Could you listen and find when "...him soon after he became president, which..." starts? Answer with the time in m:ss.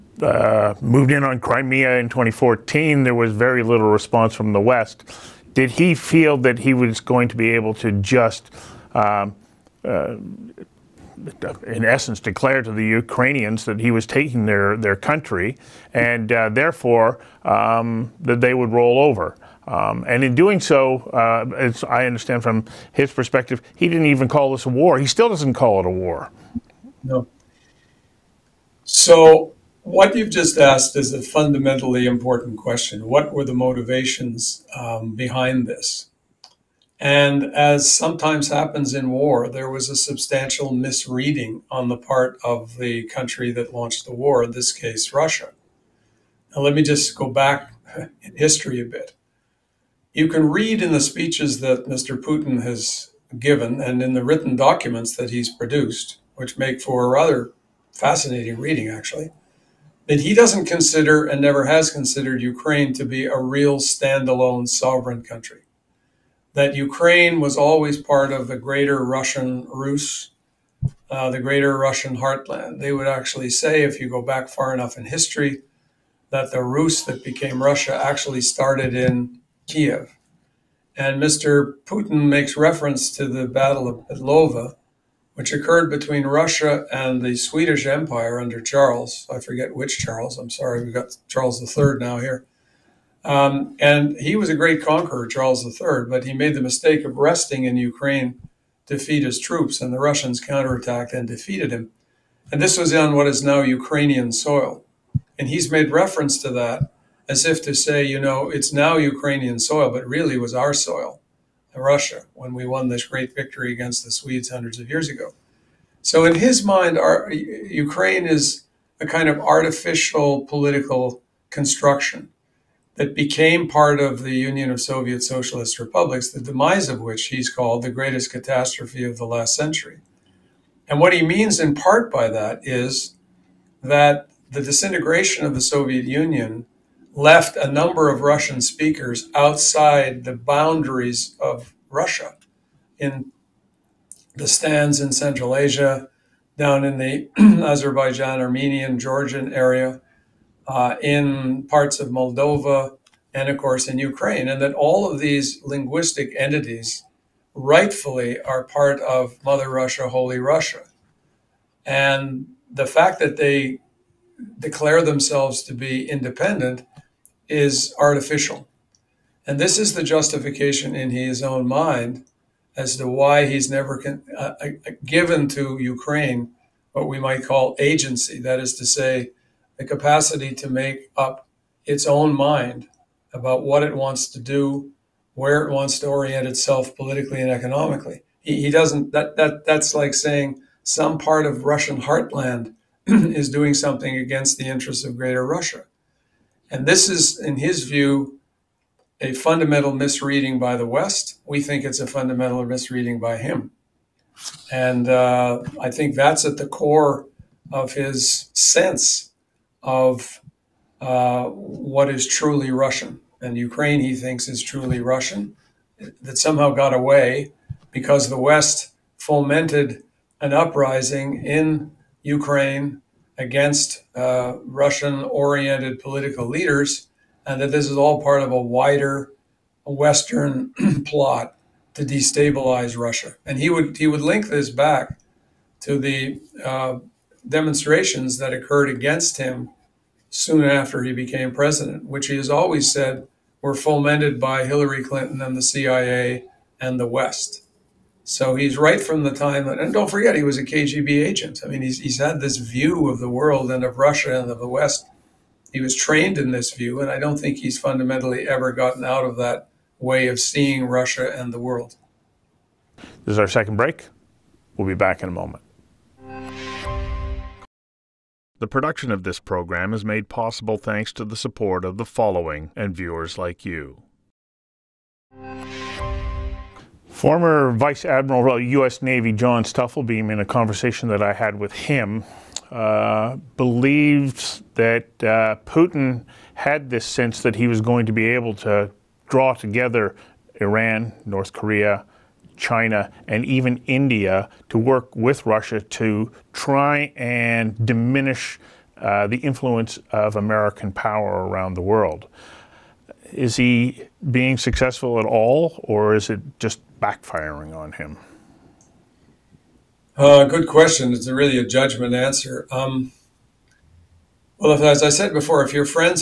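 3:59.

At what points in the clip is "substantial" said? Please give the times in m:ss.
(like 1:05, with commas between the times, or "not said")
0:39.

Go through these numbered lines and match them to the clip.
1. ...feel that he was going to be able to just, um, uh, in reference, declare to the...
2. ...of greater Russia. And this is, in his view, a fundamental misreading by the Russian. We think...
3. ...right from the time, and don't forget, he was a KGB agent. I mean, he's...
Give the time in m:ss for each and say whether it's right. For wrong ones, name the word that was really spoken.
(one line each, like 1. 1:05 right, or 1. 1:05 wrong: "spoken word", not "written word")
1. 0:05 wrong: "essence", not "reference"
2. 3:15 wrong: "West", not "Russian"
3. 4:08 right.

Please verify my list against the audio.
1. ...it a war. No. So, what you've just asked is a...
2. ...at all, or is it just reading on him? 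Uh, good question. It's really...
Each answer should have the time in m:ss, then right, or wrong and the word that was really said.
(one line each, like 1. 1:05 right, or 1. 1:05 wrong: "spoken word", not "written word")
1. 0:25 right
2. 5:05 wrong: "backfiring", not "reading".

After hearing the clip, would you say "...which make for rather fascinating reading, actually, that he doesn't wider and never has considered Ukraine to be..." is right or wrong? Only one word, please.
wrong.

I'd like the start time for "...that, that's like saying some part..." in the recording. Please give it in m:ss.
3:09.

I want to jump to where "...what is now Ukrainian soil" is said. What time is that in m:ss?
1:43.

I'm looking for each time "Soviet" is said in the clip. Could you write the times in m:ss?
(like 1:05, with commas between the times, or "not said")
2:04, 2:15.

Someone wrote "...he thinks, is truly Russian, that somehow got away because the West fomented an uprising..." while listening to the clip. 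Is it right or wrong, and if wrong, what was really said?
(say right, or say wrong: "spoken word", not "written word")
right.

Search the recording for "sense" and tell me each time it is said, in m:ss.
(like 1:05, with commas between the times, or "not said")
3:28, 4:47.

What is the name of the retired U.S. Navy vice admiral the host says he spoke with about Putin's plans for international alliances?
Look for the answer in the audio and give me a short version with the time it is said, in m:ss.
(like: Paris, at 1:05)
John Stufflebeem, at 4:39.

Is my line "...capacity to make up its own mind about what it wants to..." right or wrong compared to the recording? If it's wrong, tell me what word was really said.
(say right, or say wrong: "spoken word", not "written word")
right.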